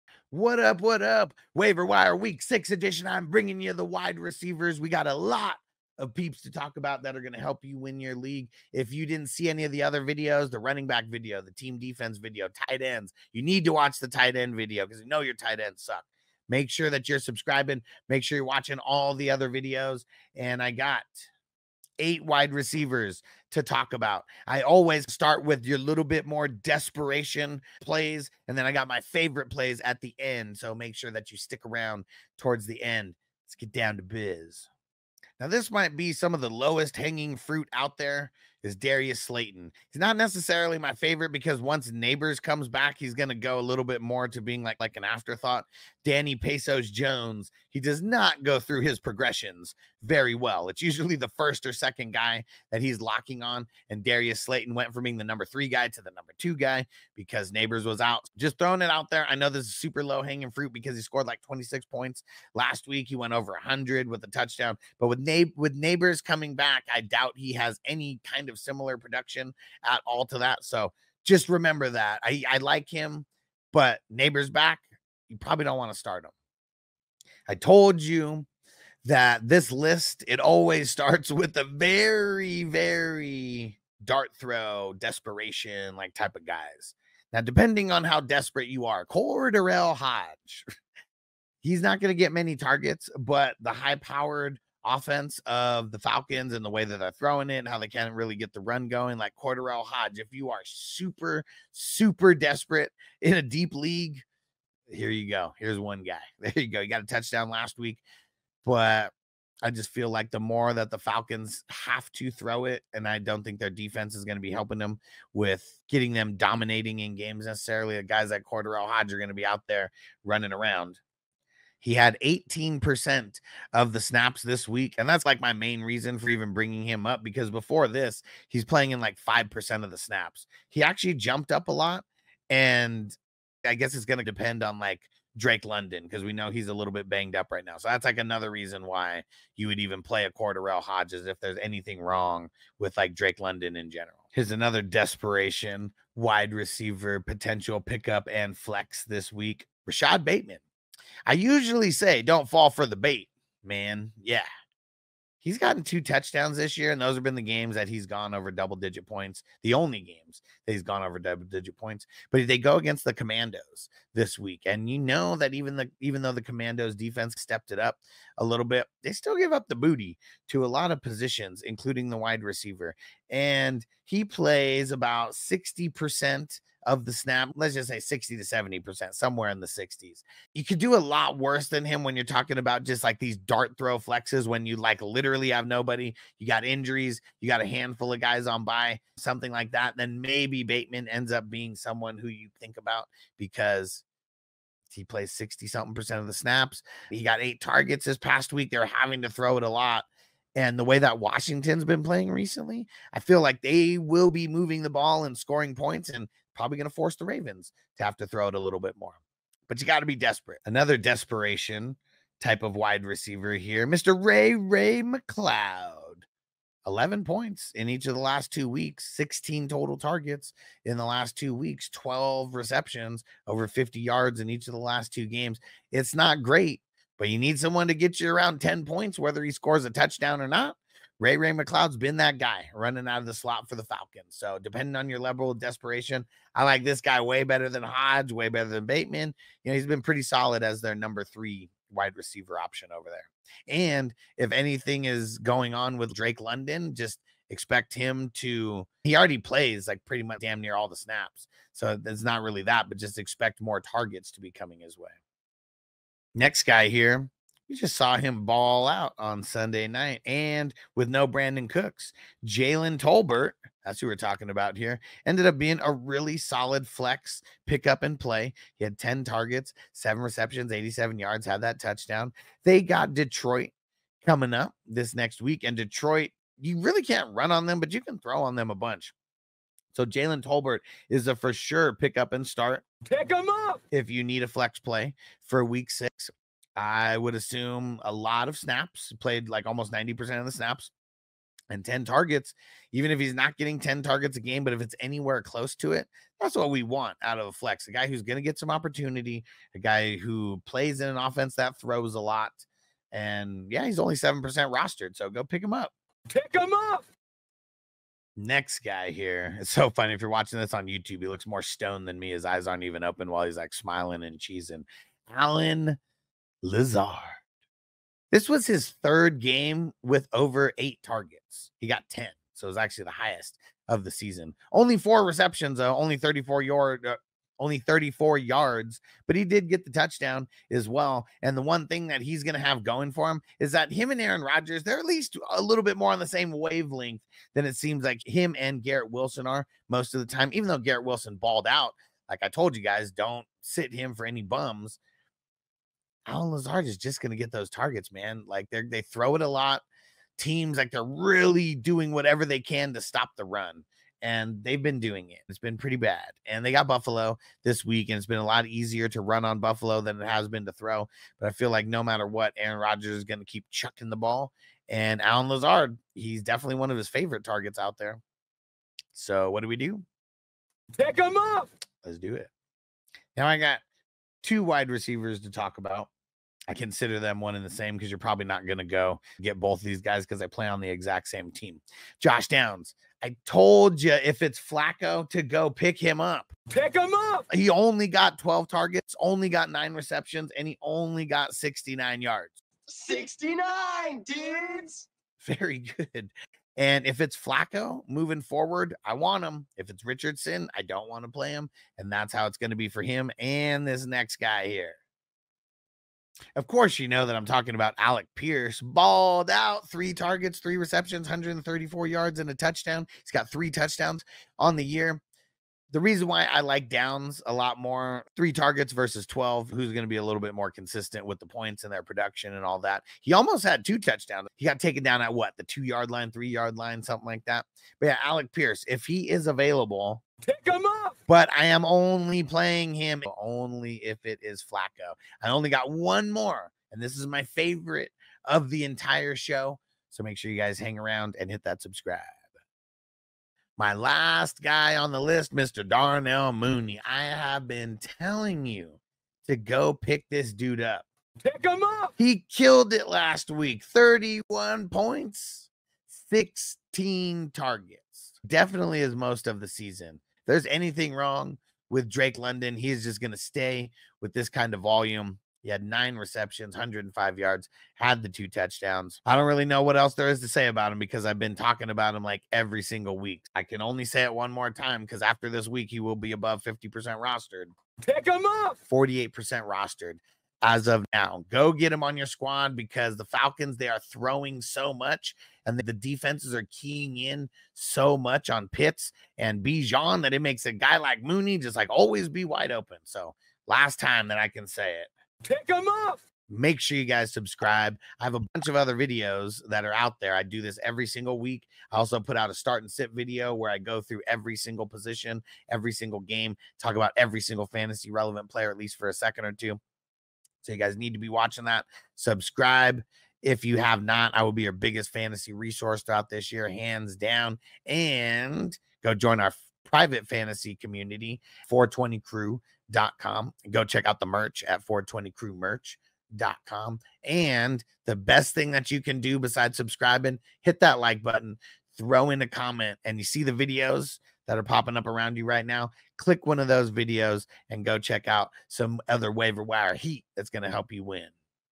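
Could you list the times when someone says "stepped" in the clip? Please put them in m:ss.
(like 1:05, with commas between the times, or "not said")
2:47.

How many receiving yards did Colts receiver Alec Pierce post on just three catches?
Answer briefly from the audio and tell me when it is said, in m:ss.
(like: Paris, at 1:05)
134, at 6:51.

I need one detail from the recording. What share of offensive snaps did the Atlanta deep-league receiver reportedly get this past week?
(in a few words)
18%.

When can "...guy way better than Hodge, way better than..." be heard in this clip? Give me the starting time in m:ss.
3:56.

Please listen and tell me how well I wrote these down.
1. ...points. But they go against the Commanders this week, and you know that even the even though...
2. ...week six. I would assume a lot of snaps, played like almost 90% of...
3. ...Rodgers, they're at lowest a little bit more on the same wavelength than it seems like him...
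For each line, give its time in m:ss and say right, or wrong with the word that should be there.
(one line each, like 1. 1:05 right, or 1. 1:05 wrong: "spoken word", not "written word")
1. 2:41 right
2. 4:45 right
3. 5:34 wrong: "least", not "lowest".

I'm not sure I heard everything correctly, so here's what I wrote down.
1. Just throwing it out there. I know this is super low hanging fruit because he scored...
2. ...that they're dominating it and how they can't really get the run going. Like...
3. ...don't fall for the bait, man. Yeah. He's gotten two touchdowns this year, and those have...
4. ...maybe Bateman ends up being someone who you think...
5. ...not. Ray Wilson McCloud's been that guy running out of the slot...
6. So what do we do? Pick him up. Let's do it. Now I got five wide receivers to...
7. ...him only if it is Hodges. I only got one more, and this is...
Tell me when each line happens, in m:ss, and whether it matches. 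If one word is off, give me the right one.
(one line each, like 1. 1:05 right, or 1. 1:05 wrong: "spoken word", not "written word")
1. 0:58 right
2. 1:36 wrong: "throwing", not "dominating"
3. 2:32 right
4. 3:10 right
5. 3:50 wrong: "Ray", not "Wilson"
6. 6:09 wrong: "two", not "five"
7. 7:12 wrong: "Flacco", not "Hodges".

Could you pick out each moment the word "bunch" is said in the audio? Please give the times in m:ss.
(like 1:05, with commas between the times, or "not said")
4:38, 8:18.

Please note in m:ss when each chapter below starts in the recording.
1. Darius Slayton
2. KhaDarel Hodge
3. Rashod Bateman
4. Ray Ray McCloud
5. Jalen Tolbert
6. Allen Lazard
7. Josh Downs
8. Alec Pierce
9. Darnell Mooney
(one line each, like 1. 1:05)
1. 0:35
2. 1:17
3. 2:24
4. 3:31
5. 4:16
6. 5:08
7. 6:13
8. 6:46
9. 7:24.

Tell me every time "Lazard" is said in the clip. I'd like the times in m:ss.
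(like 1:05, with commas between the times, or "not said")
5:16, 5:46, 6:05.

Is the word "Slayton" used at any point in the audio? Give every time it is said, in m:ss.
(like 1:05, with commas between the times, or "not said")
0:39, 0:54.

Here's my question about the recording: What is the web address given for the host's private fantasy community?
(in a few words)
420crew.com.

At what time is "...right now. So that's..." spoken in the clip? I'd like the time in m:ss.
2:17.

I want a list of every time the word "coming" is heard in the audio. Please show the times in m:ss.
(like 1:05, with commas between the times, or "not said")
1:06, 4:14, 4:34.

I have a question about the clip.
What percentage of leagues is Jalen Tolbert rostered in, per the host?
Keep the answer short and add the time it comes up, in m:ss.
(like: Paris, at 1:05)
7%, at 5:04.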